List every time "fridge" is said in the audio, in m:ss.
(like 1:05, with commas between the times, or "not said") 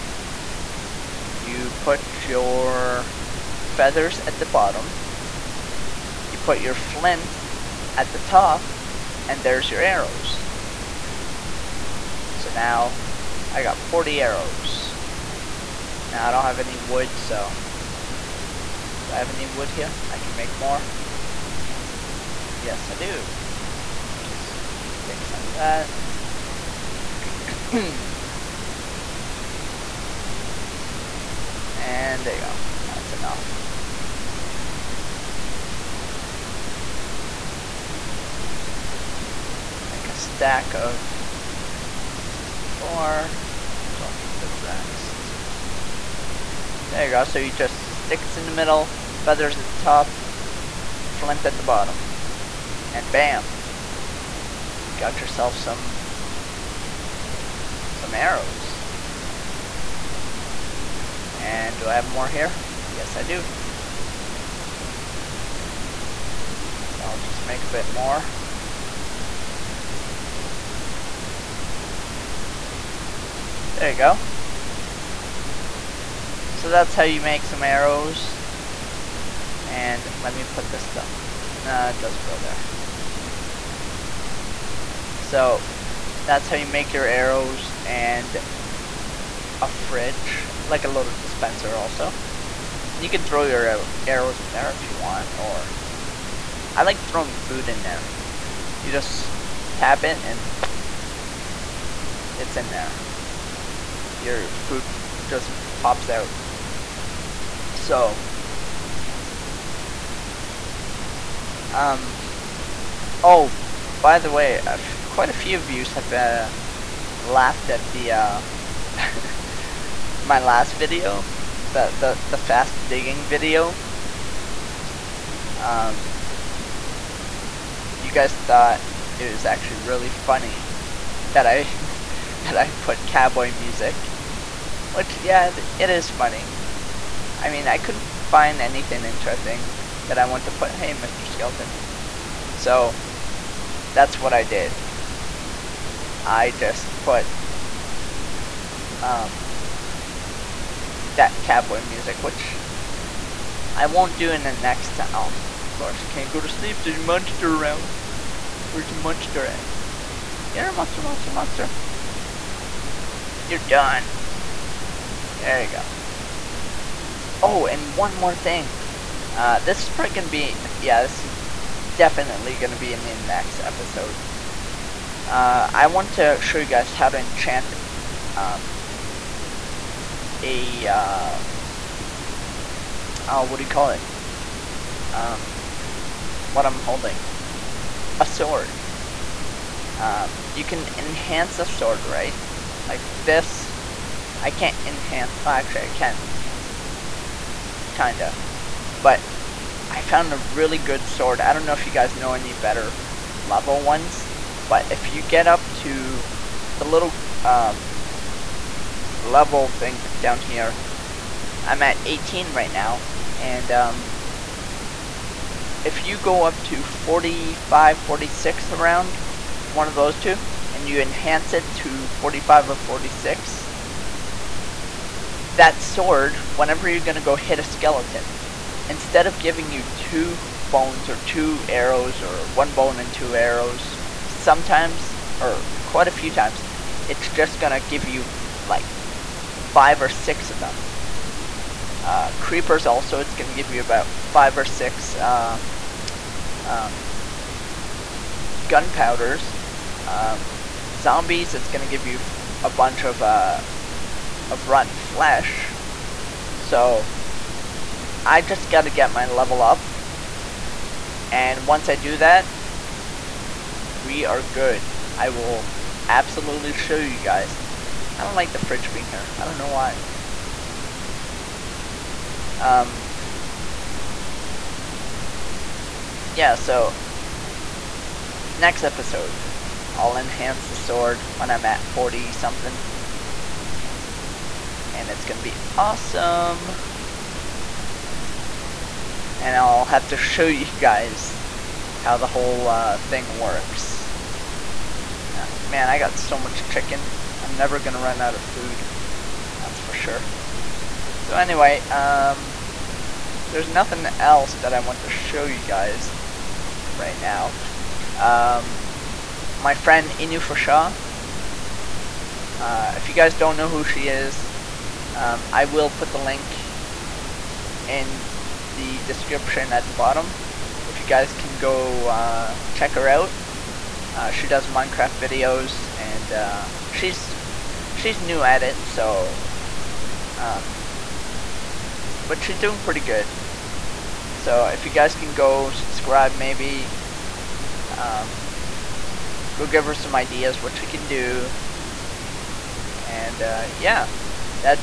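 1:29, 4:28.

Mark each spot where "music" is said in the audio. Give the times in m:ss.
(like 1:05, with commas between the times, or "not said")
2:13, 2:31.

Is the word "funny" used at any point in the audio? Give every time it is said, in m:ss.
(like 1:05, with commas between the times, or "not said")
2:10, 2:16.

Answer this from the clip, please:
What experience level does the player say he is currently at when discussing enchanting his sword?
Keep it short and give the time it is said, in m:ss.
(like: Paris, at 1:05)
18, at 3:32.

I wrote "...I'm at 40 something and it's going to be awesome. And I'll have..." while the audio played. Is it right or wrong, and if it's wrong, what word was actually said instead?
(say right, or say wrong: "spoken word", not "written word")
right.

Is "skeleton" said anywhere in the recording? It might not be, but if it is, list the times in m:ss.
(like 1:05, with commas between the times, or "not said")
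2:21, 3:47.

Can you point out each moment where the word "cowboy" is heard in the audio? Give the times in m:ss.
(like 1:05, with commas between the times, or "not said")
2:13, 2:31.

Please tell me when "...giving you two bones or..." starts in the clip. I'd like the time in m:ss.
3:49.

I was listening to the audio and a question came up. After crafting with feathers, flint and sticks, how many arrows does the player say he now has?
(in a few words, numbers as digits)
40.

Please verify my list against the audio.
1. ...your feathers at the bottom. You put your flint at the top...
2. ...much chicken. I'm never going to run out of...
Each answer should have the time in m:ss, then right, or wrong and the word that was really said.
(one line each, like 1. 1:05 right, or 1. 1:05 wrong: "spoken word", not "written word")
1. 0:02 right
2. 4:56 right.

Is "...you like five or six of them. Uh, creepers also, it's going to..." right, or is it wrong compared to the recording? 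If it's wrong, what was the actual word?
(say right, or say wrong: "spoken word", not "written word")
right.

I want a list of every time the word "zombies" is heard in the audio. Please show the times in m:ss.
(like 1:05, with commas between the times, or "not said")
4:10.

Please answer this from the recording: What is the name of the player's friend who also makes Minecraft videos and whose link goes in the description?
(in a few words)
Inu Fusha.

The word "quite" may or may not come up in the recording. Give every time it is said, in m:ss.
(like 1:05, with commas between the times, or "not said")
1:55, 3:55.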